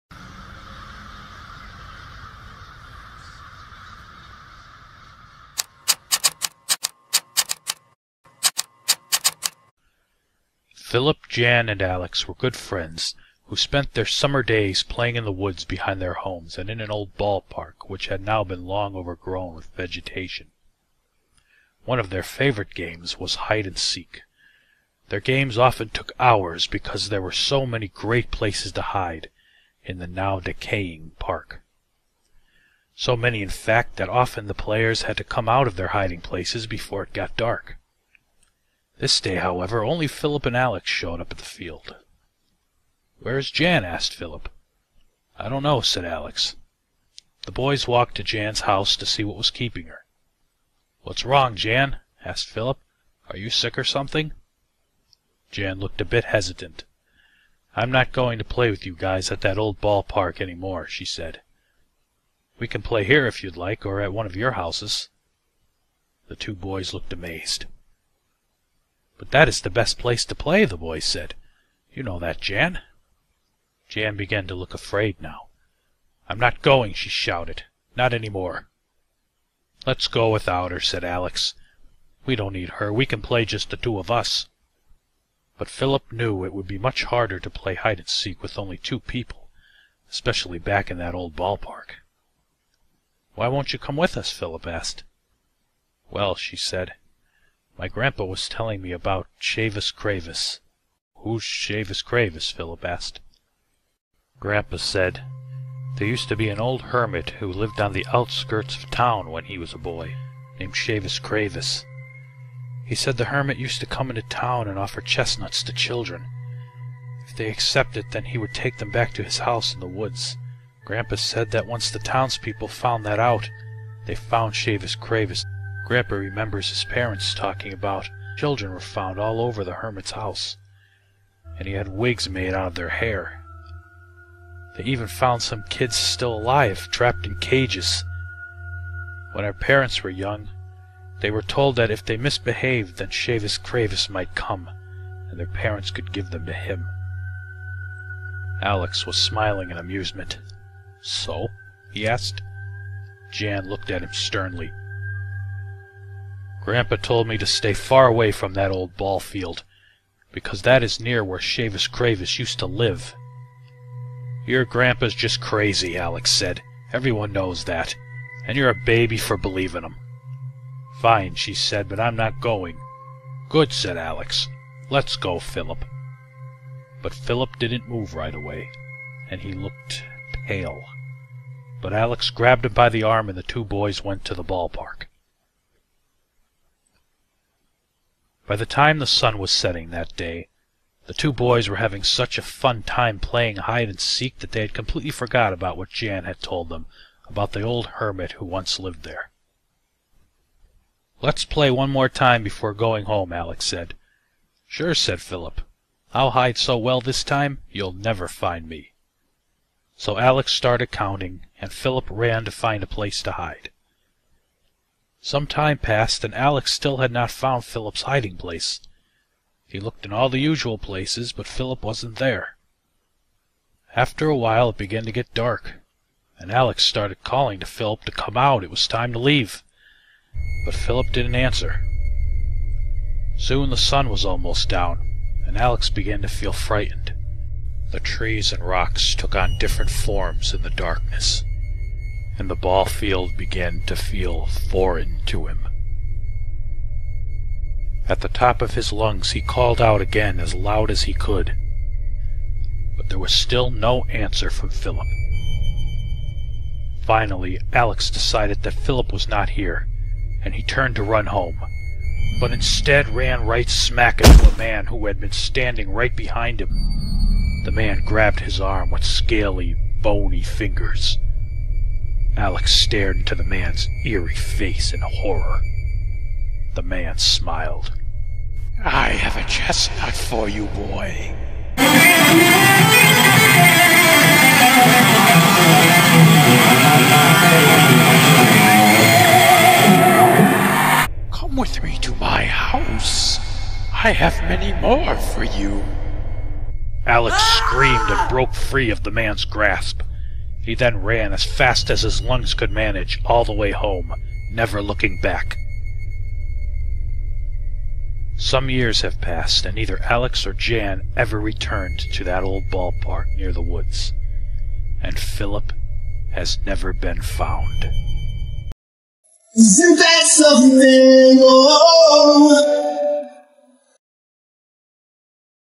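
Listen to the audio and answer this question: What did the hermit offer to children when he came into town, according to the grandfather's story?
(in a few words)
chestnuts.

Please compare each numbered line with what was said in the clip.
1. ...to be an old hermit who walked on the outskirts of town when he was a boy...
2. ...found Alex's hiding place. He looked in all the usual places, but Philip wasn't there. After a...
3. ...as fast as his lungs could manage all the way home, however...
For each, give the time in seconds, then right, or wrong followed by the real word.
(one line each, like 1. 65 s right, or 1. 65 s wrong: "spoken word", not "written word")
1. 106 s wrong: "lived", not "walked"
2. 217 s wrong: "Philip", not "Alex"
3. 301 s wrong: "never", not "however".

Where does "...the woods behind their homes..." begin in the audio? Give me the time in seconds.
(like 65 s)
15 s.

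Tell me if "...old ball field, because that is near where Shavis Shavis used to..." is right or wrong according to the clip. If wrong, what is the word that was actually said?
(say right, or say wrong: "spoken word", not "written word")
wrong: "Cravis", not "Shavis".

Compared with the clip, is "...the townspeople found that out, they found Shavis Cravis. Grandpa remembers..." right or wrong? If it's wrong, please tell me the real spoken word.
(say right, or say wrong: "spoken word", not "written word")
right.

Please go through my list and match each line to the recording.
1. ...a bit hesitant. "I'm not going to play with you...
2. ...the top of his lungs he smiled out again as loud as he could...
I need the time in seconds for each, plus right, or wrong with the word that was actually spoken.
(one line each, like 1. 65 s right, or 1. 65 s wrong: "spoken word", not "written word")
1. 56 s right
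2. 248 s wrong: "called", not "smiled".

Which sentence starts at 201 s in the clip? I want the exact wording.
"Let's play one more time before going home," Alex said.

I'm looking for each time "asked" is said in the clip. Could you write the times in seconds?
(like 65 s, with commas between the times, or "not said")
43 s, 52 s, 94 s, 102 s, 152 s.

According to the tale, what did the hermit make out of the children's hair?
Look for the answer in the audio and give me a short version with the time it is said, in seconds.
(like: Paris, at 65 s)
wigs, at 131 s.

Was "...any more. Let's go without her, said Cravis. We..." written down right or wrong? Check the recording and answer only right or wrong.
wrong.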